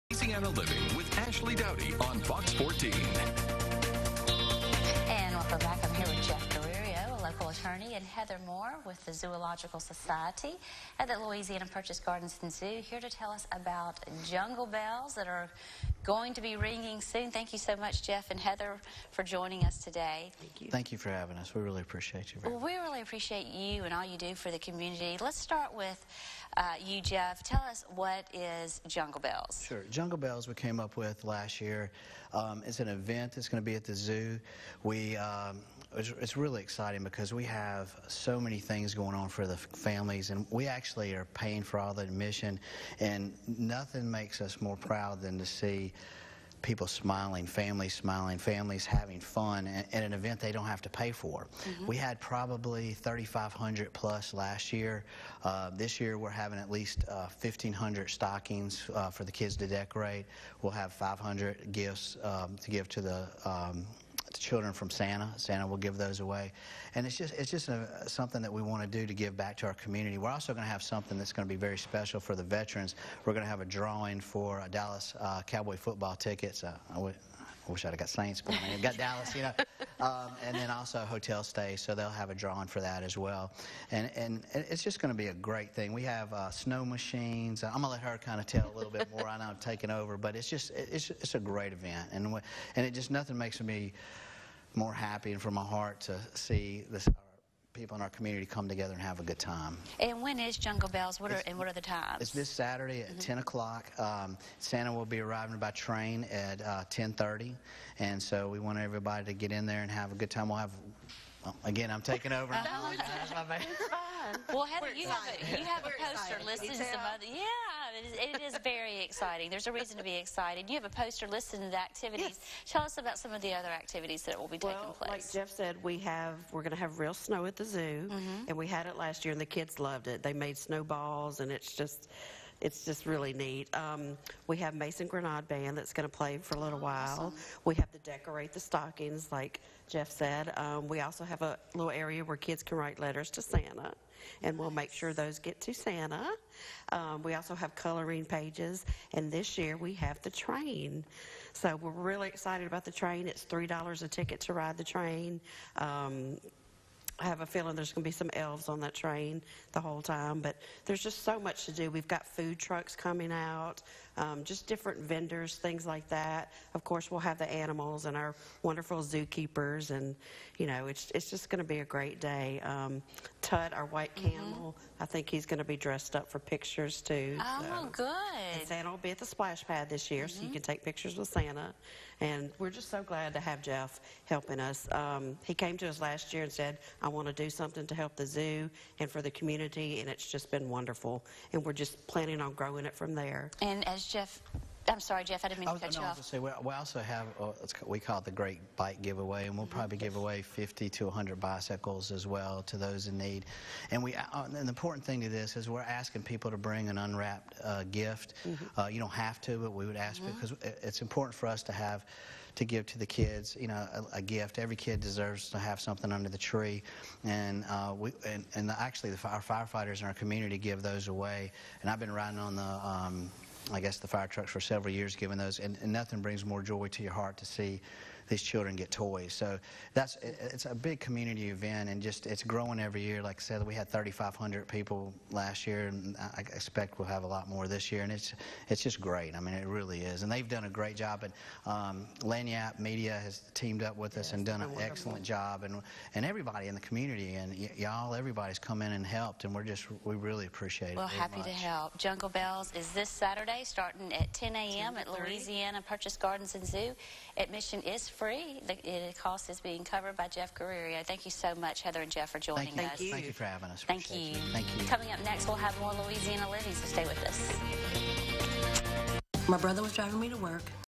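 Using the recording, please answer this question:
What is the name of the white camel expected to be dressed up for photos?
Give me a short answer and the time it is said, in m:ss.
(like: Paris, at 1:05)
Tut, at 2:53.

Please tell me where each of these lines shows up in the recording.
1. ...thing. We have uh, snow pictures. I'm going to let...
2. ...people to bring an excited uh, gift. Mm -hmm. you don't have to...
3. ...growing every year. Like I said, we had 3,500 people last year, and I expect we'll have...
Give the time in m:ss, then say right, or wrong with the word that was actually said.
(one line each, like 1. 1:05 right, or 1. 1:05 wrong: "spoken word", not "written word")
1. 1:25 wrong: "machines", not "pictures"
2. 3:26 wrong: "unwrapped", not "excited"
3. 3:52 right.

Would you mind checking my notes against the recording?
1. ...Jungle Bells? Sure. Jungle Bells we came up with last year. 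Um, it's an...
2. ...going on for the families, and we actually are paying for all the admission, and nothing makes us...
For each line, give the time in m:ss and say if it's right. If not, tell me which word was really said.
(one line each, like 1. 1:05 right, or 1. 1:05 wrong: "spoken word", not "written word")
1. 0:28 right
2. 0:38 right.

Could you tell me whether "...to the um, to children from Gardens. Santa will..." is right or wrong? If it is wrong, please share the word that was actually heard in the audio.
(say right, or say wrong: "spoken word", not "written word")
wrong: "Santa", not "Gardens".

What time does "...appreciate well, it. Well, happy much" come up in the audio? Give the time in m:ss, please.
4:10.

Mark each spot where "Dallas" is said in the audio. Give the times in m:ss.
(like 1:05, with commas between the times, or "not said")
1:14, 1:18.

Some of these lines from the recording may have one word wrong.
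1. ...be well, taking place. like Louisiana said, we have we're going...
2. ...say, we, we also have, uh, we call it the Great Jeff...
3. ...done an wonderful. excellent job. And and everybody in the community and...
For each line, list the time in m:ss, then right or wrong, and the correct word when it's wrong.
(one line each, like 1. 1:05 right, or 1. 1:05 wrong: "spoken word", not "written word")
1. 2:04 wrong: "Jeff", not "Louisiana"
2. 3:16 wrong: "Bike", not "Jeff"
3. 4:04 right.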